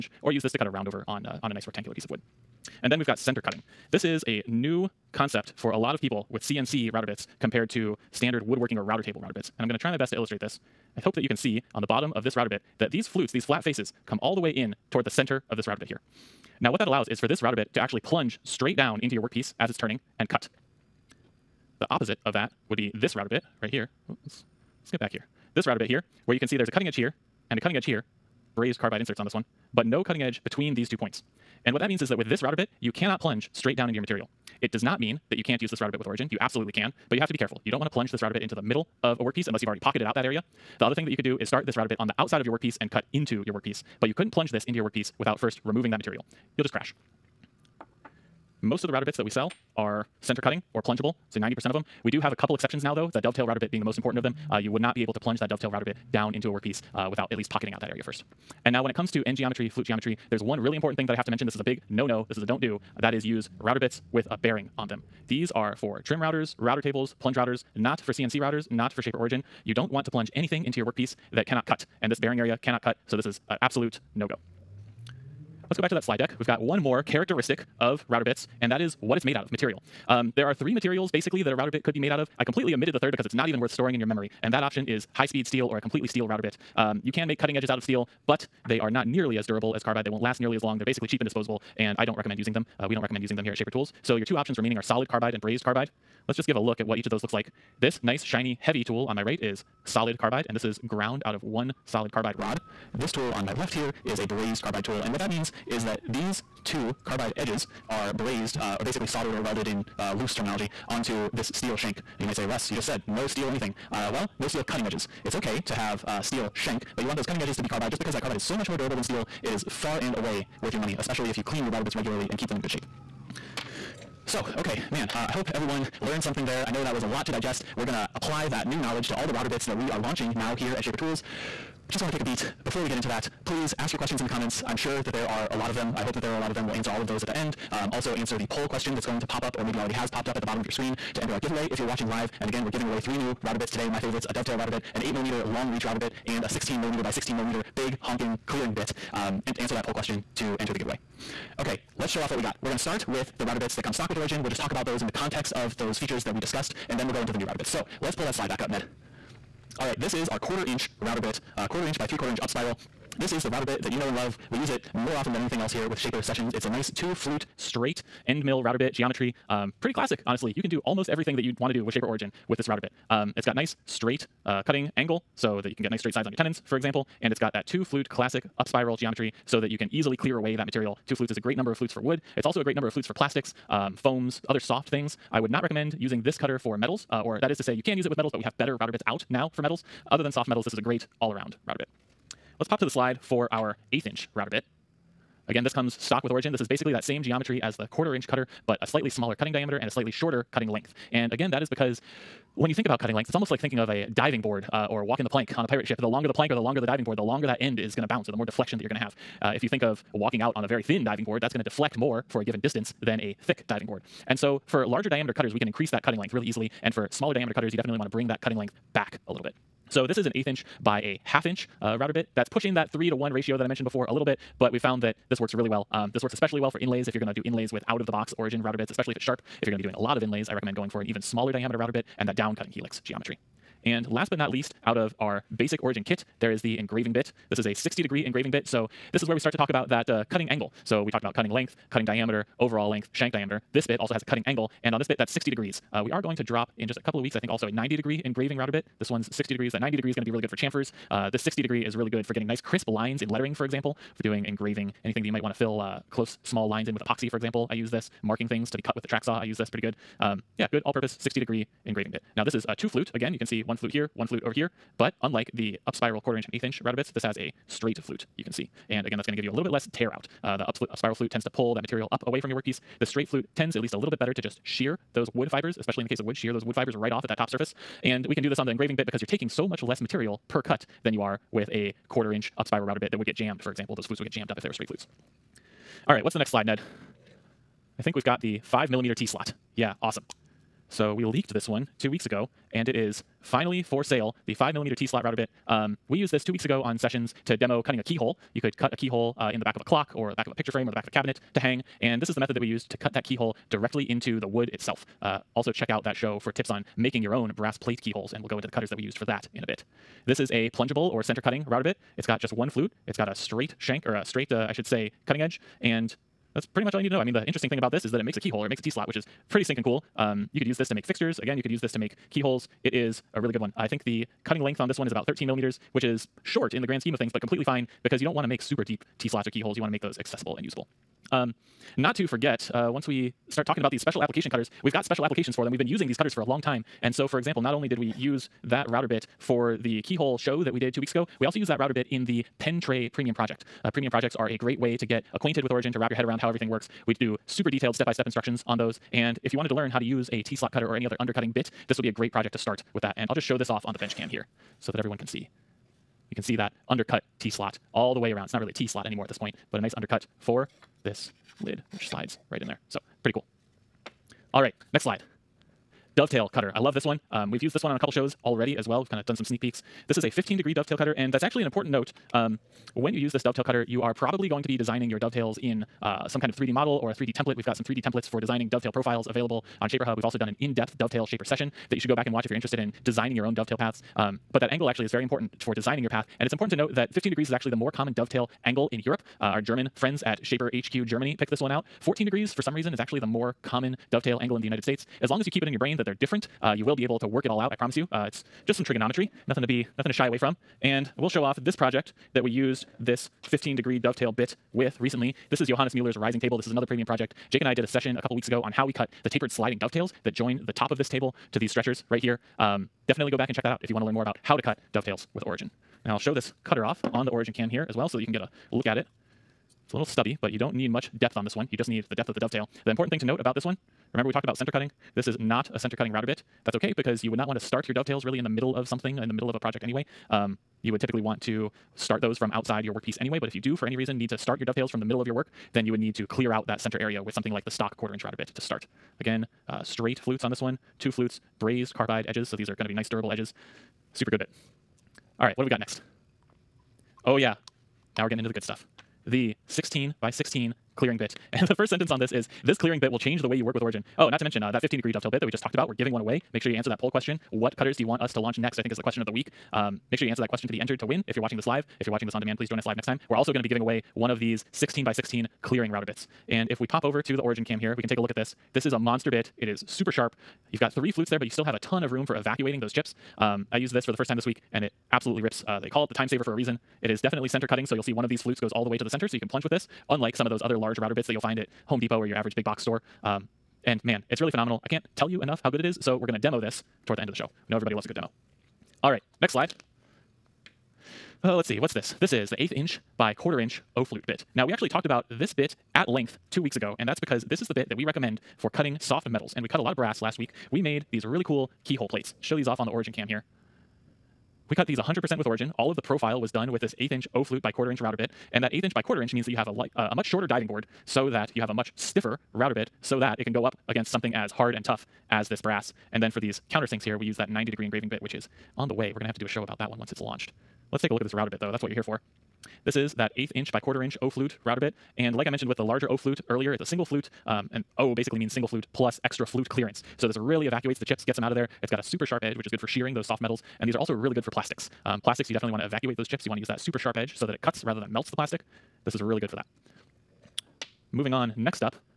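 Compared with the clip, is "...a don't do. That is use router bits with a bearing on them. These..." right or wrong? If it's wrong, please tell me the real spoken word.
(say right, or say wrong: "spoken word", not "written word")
right.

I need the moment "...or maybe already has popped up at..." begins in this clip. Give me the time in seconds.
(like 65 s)
139 s.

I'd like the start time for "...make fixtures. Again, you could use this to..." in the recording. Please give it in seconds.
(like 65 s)
320 s.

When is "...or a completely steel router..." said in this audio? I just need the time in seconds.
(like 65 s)
85 s.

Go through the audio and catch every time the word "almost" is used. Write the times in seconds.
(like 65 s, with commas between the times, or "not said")
170 s, 203 s.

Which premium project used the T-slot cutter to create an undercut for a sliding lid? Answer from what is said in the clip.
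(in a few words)
Pen Tray.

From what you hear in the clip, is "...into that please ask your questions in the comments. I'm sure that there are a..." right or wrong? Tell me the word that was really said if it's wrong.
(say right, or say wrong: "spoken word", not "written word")
right.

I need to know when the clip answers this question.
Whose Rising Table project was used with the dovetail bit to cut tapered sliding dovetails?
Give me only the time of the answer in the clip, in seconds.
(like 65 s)
405 s.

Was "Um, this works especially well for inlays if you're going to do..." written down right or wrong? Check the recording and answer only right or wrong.
right.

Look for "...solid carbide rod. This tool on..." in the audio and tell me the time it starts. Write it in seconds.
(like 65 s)
101 s.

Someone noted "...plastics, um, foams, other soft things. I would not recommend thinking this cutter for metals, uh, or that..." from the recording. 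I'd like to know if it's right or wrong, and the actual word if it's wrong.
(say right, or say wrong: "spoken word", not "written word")
wrong: "using", not "thinking".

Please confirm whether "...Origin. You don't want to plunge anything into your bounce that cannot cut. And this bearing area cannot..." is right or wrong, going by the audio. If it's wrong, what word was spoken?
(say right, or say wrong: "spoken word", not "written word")
wrong: "workpiece", not "bounce".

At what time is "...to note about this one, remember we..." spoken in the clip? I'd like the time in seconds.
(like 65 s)
423 s.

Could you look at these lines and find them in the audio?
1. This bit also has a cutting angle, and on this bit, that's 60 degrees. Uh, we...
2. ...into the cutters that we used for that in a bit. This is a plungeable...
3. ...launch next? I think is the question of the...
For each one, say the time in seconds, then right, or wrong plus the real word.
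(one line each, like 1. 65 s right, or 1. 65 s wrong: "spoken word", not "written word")
1. 243 s right
2. 308 s right
3. 458 s right.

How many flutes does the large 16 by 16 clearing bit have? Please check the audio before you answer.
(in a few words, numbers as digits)
3.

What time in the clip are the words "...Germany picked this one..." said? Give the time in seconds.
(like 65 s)
391 s.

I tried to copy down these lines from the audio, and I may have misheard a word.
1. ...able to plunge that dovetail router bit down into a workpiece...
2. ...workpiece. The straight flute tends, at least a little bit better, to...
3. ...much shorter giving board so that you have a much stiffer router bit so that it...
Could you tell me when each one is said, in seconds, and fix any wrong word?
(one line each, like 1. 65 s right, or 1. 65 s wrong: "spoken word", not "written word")
1. 55 s right
2. 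272 s right
3. 510 s wrong: "diving", not "giving".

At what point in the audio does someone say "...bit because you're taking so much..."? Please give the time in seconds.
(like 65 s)
278 s.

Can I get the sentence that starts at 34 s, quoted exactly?
It does not mean that you can't use this router bit with origin.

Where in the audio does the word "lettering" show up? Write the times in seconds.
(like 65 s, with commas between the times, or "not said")
253 s.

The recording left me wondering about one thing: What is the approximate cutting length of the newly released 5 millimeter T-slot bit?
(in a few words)
13 millimeters.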